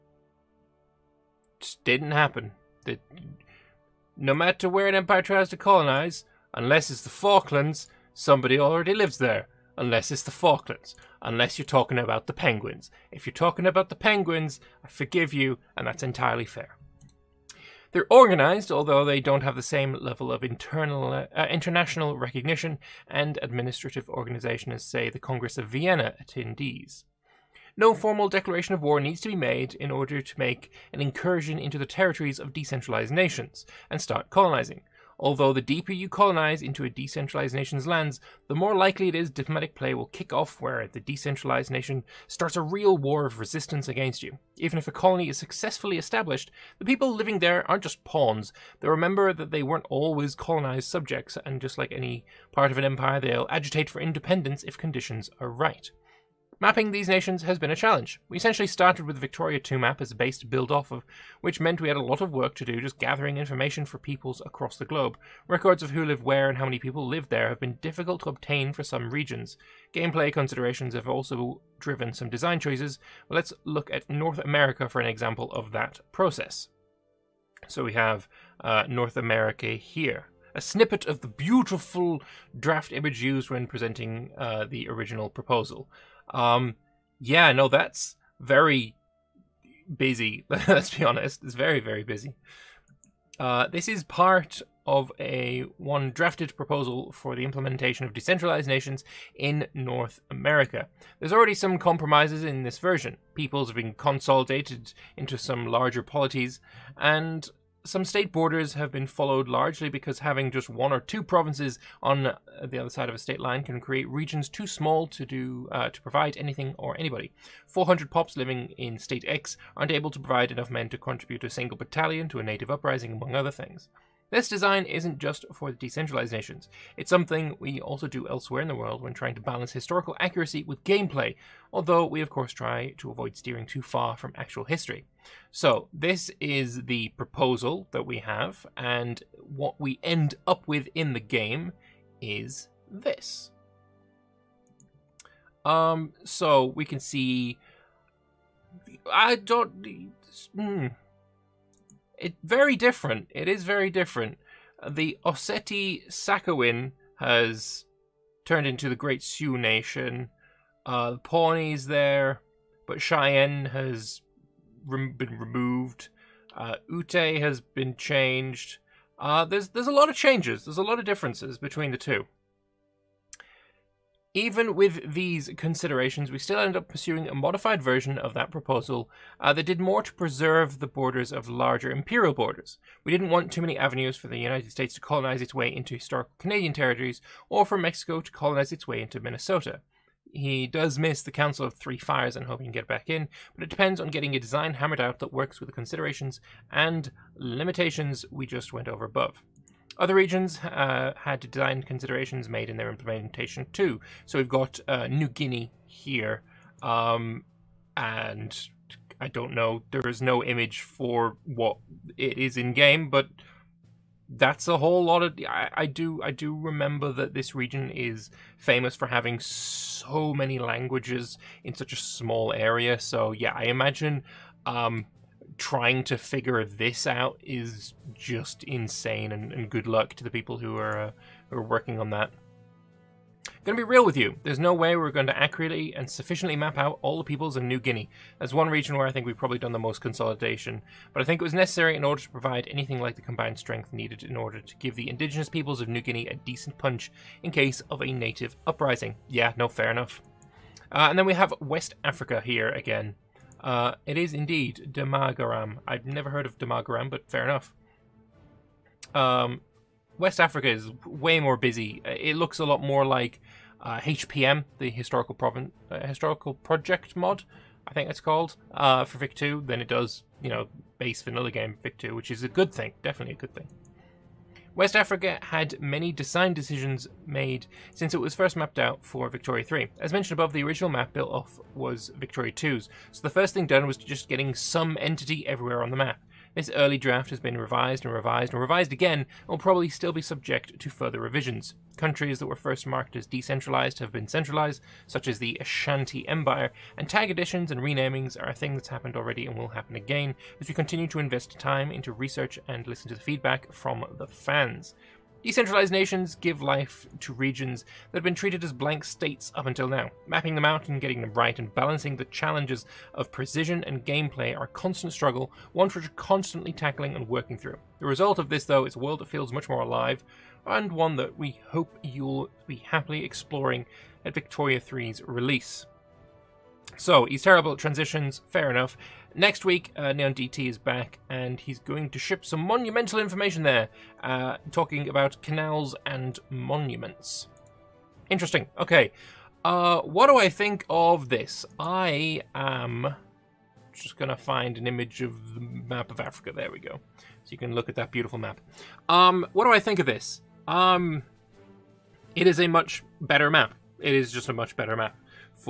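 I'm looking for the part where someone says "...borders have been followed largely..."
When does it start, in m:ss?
1:48.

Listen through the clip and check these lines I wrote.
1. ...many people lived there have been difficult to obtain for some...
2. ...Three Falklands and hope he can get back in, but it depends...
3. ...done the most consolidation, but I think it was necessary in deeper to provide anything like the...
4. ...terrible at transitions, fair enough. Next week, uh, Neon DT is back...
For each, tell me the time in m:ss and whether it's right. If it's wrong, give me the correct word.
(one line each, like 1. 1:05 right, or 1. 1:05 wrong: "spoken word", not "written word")
1. 1:06 right
2. 3:11 wrong: "Fires", not "Falklands"
3. 3:59 wrong: "order", not "deeper"
4. 5:27 right.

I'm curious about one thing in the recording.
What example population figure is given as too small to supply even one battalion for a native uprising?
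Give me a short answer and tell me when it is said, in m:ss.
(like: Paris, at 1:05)
400, at 1:57.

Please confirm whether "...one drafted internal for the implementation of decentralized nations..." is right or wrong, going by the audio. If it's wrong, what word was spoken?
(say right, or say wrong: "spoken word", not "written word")
wrong: "proposal", not "internal".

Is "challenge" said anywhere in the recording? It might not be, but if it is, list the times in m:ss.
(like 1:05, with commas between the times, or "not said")
0:57, 5:12.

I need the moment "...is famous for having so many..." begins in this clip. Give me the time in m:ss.
3:37.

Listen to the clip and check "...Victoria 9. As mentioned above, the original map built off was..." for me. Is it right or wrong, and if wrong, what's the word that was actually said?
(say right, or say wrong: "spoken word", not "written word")
wrong: "3", not "9".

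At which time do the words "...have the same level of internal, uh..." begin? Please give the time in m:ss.
0:19.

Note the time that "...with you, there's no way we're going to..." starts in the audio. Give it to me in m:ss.
3:54.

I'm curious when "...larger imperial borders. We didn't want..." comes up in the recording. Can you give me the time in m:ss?
3:01.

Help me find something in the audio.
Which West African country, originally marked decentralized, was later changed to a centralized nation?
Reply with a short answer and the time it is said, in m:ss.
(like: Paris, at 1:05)
Ashanti Empire, at 4:55.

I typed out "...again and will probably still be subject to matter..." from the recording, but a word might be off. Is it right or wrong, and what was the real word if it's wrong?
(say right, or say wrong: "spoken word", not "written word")
wrong: "further", not "matter".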